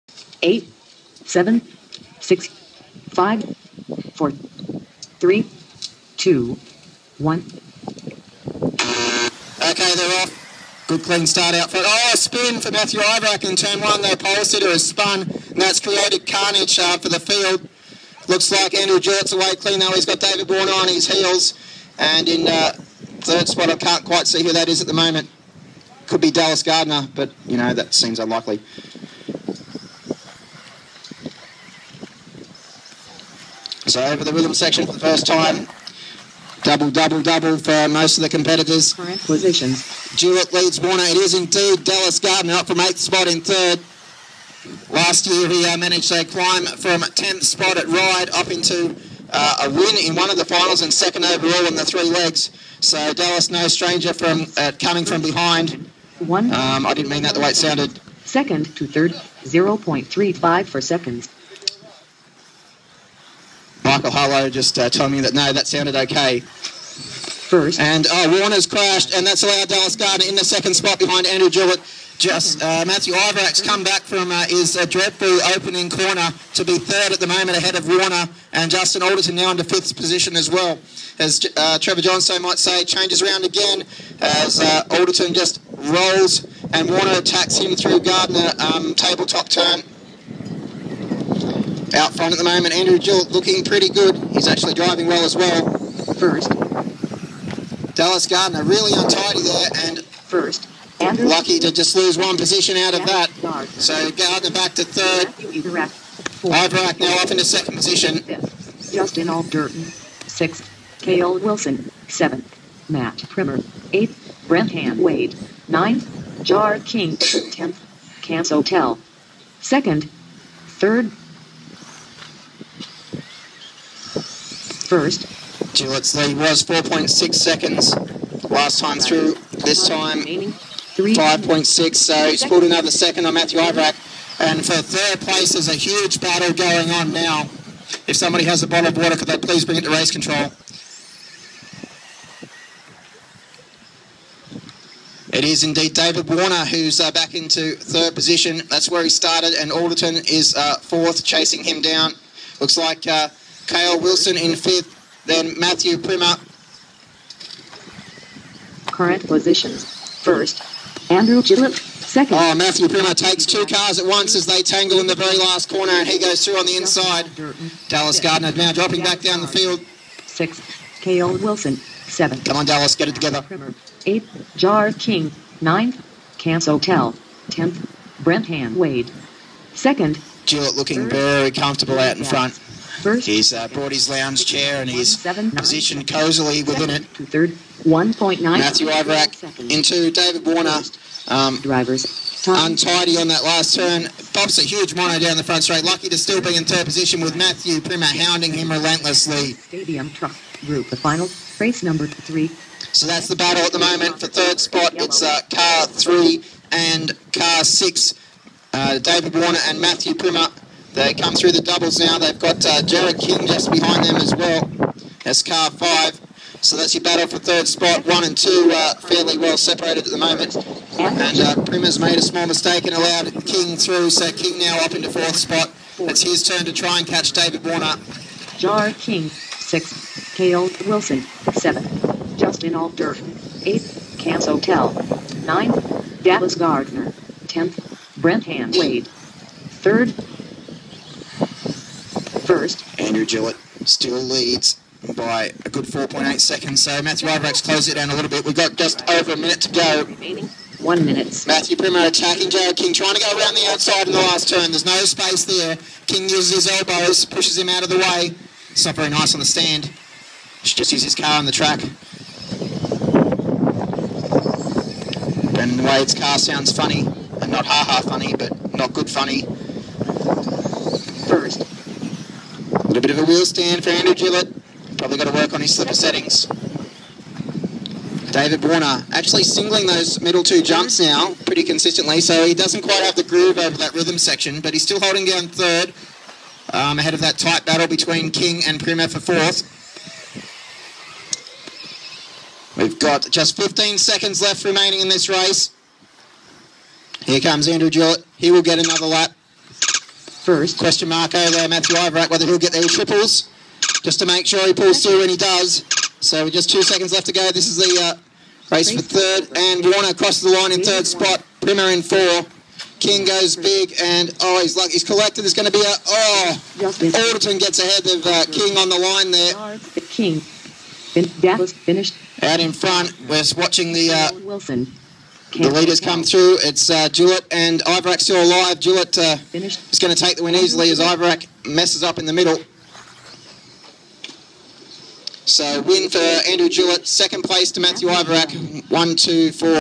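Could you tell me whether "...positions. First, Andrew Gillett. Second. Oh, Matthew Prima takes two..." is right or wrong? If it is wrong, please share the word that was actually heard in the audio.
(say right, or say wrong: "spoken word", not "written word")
right.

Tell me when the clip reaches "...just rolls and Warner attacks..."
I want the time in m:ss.
1:25.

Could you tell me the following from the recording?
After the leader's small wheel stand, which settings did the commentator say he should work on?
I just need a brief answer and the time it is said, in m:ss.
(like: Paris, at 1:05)
Slipper settings, at 4:35.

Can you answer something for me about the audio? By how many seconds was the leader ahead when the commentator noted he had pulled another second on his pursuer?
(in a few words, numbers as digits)
5.6.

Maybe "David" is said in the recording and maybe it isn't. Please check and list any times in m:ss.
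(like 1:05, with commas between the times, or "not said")
0:20, 2:25, 3:10, 3:28, 3:47, 4:38.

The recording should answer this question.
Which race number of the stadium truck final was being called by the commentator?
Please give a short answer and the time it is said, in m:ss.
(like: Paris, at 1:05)
3, at 3:21.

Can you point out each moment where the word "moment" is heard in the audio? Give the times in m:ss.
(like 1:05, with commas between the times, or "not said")
0:24, 1:17, 1:32, 3:23, 3:40.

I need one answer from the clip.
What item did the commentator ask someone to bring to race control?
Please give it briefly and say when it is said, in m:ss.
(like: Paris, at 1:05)
A bottle of water, at 2:18.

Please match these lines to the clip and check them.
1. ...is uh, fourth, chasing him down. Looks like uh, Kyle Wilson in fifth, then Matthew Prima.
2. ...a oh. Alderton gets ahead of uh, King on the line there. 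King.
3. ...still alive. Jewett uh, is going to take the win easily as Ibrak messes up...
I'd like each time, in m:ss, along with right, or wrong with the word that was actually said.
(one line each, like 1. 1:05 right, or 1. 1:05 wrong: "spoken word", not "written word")
1. 2:30 right
2. 5:15 right
3. 5:28 wrong: "Ivrak", not "Ibrak".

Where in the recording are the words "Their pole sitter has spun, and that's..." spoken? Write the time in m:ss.
0:14.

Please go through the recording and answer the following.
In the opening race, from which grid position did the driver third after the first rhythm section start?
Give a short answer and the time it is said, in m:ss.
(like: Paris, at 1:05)
8th, at 0:42.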